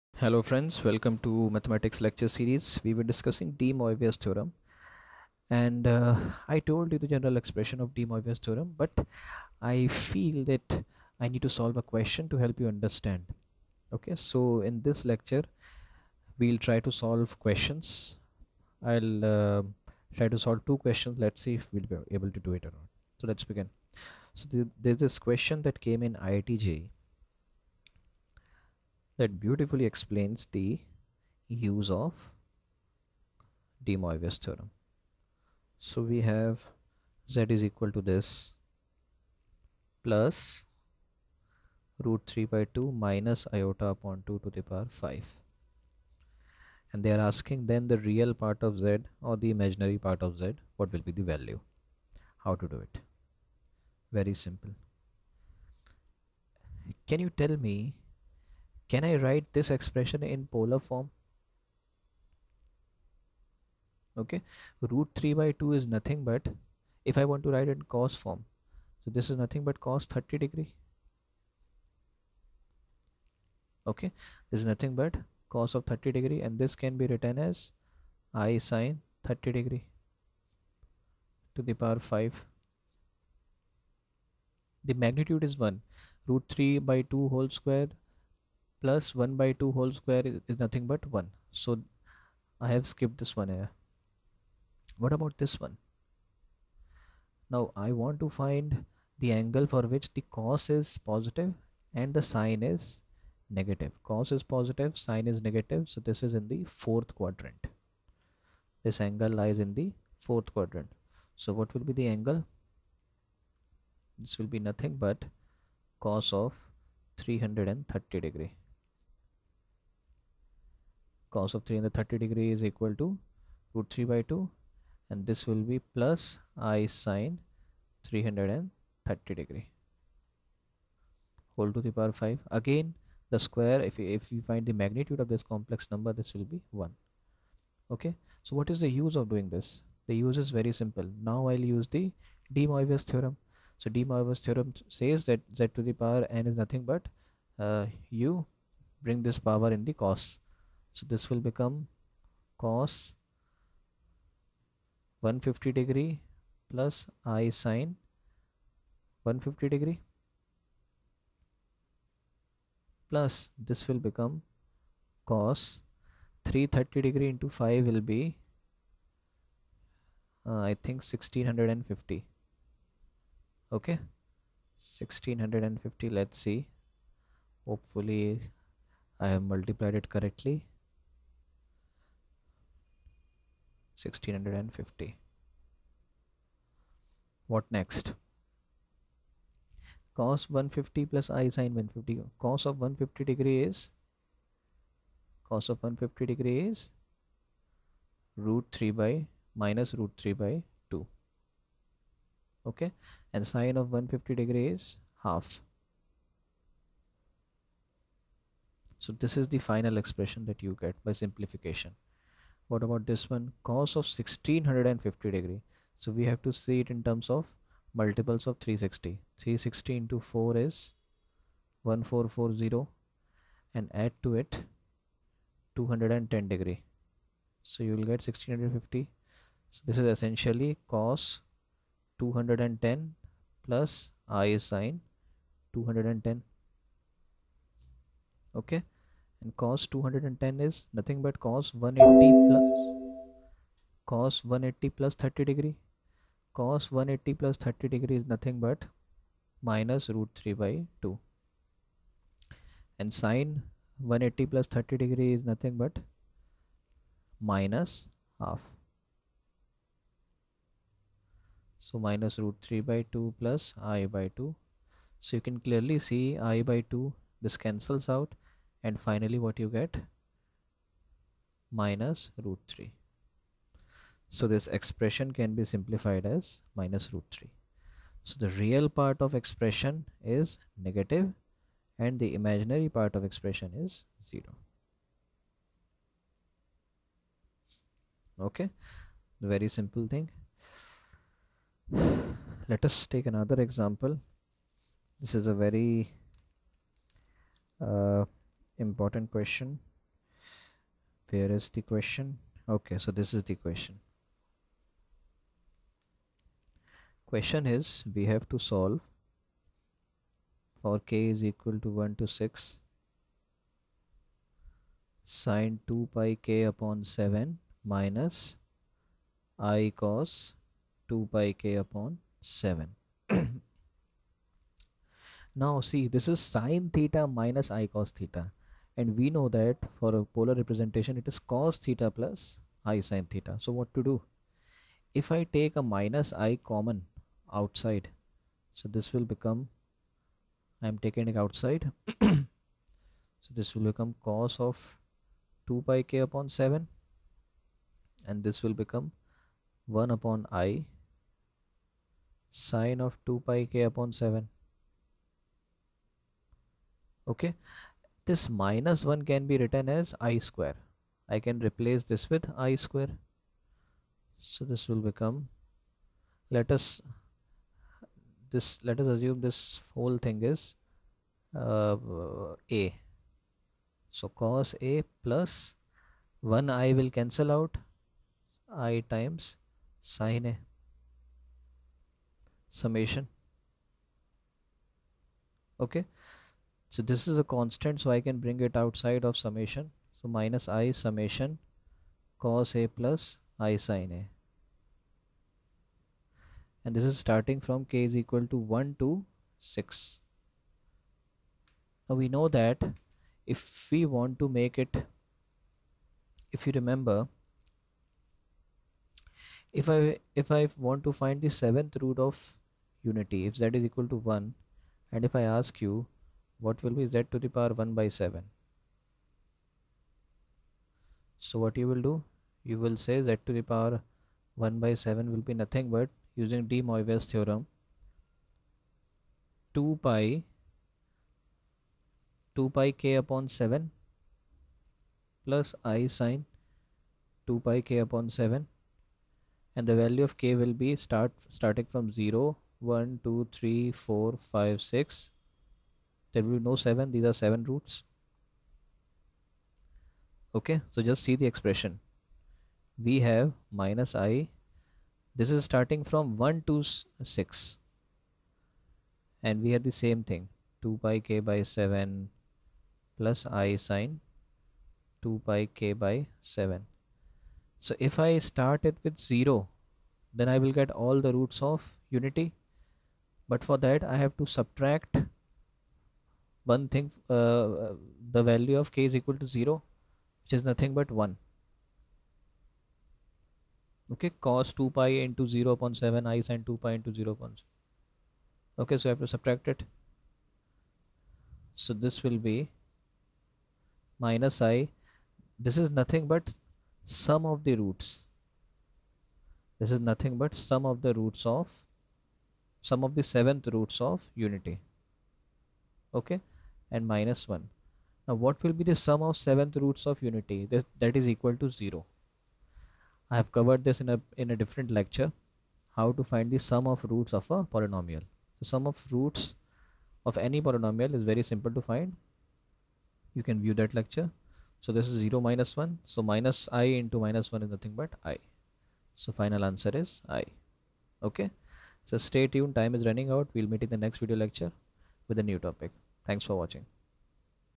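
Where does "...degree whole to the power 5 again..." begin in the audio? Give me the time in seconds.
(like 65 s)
129 s.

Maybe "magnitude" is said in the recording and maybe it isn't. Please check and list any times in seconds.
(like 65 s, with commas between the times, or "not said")
85 s, 134 s.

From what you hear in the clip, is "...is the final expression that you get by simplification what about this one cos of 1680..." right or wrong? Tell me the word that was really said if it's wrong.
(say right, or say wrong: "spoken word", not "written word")
wrong: "1650", not "1680".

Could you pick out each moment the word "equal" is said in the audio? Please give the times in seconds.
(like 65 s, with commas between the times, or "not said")
37 s, 122 s, 311 s, 398 s, 413 s, 479 s, 511 s.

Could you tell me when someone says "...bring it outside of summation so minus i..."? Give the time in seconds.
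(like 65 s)
388 s.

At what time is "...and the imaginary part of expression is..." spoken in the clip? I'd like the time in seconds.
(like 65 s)
281 s.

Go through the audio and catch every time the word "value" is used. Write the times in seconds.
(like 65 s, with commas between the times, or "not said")
51 s, 440 s, 478 s.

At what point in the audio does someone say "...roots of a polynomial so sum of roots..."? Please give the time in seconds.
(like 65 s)
517 s.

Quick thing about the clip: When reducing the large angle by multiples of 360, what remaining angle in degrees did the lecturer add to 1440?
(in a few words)
210.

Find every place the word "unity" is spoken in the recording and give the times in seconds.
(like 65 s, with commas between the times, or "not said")
413 s, 472 s, 504 s, 510 s.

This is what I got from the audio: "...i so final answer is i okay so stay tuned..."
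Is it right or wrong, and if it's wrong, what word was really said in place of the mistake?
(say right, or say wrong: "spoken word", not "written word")
right.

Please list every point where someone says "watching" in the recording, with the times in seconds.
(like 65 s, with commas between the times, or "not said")
536 s.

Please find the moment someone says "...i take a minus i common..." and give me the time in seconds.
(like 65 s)
335 s.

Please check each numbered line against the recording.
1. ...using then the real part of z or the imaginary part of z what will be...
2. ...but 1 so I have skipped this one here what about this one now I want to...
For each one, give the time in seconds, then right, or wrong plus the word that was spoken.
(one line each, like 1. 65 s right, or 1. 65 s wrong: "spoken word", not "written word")
1. 47 s wrong: "asking", not "using"
2. 90 s right.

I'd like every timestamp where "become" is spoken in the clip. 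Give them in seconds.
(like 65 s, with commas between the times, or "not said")
151 s, 164 s, 339 s, 343 s, 348 s, 365 s.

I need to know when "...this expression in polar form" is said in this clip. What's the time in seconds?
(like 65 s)
59 s.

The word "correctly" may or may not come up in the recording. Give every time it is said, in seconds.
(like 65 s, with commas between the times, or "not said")
180 s.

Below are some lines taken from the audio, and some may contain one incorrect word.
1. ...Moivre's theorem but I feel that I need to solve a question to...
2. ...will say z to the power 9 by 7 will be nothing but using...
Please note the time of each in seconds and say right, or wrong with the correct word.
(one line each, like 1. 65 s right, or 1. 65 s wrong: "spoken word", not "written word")
1. 8 s right
2. 422 s wrong: "1", not "9".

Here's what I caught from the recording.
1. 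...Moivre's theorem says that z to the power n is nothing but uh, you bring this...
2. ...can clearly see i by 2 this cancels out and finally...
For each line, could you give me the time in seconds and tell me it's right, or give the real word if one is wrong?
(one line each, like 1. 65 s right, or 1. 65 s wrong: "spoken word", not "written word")
1. 144 s right
2. 265 s right.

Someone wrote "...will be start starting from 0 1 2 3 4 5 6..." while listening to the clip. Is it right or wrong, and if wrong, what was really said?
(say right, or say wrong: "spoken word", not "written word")
right.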